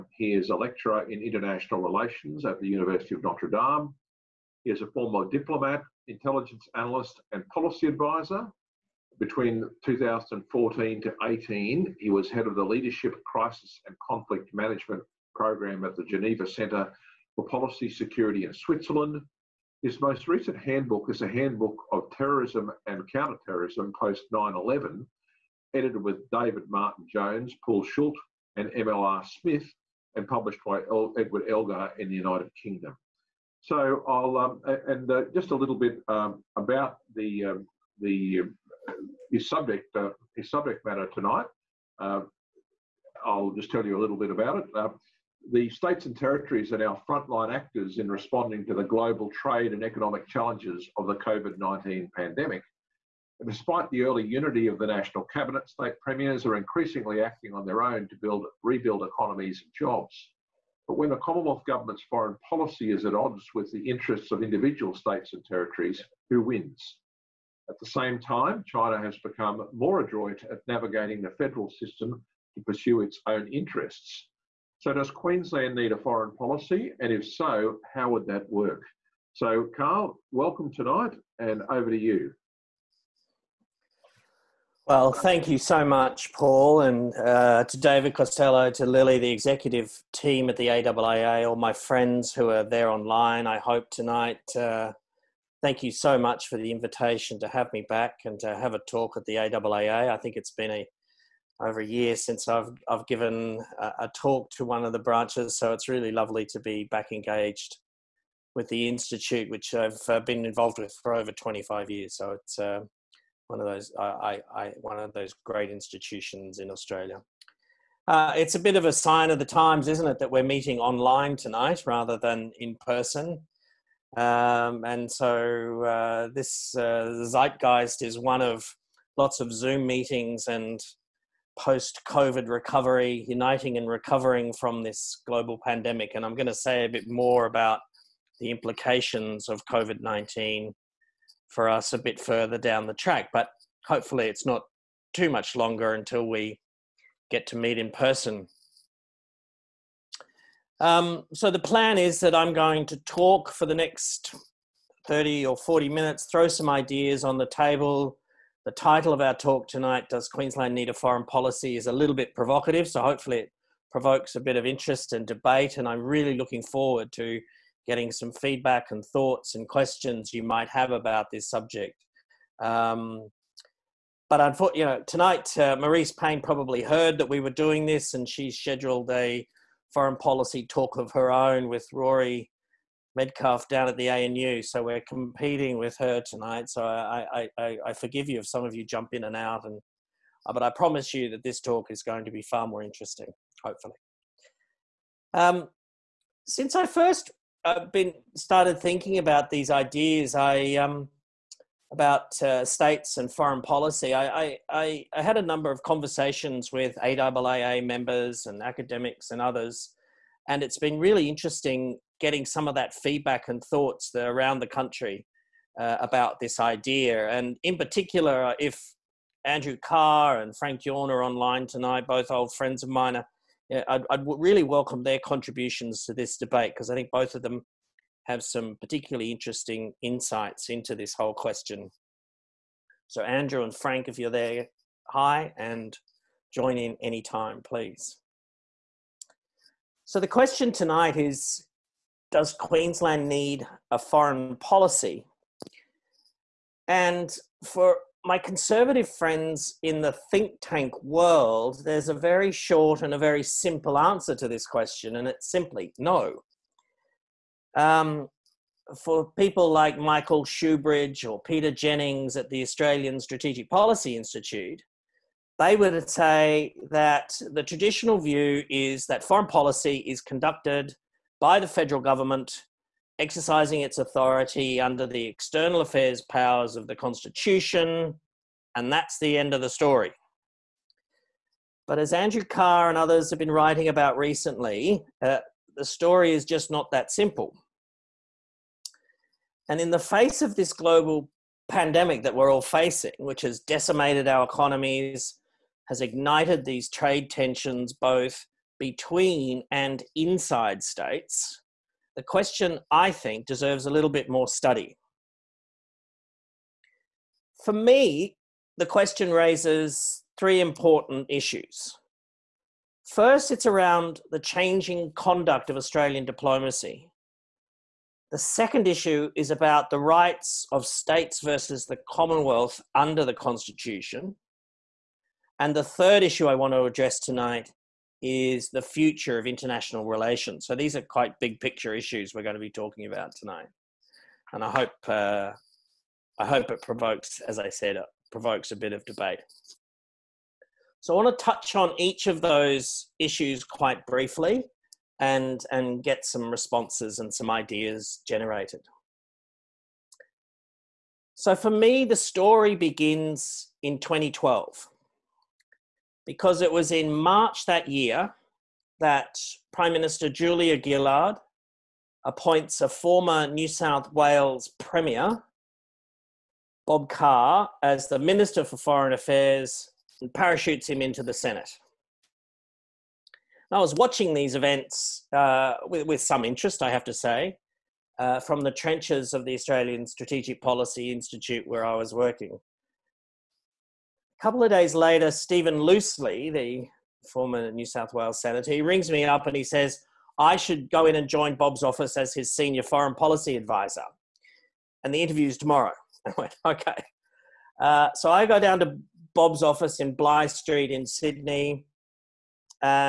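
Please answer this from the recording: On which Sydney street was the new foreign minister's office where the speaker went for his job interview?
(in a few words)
Bligh Street.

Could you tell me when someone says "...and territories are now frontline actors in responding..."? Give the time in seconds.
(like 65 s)
46 s.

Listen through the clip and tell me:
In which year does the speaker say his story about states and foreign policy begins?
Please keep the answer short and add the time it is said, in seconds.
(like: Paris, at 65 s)
2012, at 353 s.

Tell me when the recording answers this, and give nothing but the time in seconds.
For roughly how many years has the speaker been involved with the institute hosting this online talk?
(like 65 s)
111 s.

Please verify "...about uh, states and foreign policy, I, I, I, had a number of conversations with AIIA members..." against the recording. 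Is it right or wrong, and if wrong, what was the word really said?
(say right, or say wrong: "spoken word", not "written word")
right.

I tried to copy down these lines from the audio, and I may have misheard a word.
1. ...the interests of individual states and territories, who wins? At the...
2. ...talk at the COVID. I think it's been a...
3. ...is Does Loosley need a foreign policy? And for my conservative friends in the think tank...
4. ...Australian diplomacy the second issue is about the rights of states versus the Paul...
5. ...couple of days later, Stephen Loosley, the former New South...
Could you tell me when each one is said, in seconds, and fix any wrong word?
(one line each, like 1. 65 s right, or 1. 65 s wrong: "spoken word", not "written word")
1. 63 s right
2. 98 s wrong: "AIIA", not "COVID"
3. 241 s wrong: "Queensland", not "Loosley"
4. 315 s wrong: "Commonwealth", not "Paul"
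5. 384 s right.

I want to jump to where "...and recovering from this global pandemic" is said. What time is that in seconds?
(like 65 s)
133 s.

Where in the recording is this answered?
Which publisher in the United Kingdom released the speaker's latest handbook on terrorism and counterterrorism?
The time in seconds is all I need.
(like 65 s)
31 s.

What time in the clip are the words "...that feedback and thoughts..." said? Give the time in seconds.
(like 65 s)
212 s.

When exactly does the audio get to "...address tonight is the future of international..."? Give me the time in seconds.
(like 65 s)
326 s.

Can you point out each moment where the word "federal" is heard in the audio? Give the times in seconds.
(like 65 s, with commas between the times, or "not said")
71 s, 271 s.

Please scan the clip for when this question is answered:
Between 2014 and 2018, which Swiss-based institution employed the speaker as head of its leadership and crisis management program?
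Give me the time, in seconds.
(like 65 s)
16 s.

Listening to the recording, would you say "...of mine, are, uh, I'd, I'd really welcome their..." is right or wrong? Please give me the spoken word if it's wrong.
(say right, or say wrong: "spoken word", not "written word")
right.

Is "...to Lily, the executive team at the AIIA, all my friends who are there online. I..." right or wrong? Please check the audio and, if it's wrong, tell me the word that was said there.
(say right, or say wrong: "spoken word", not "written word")
right.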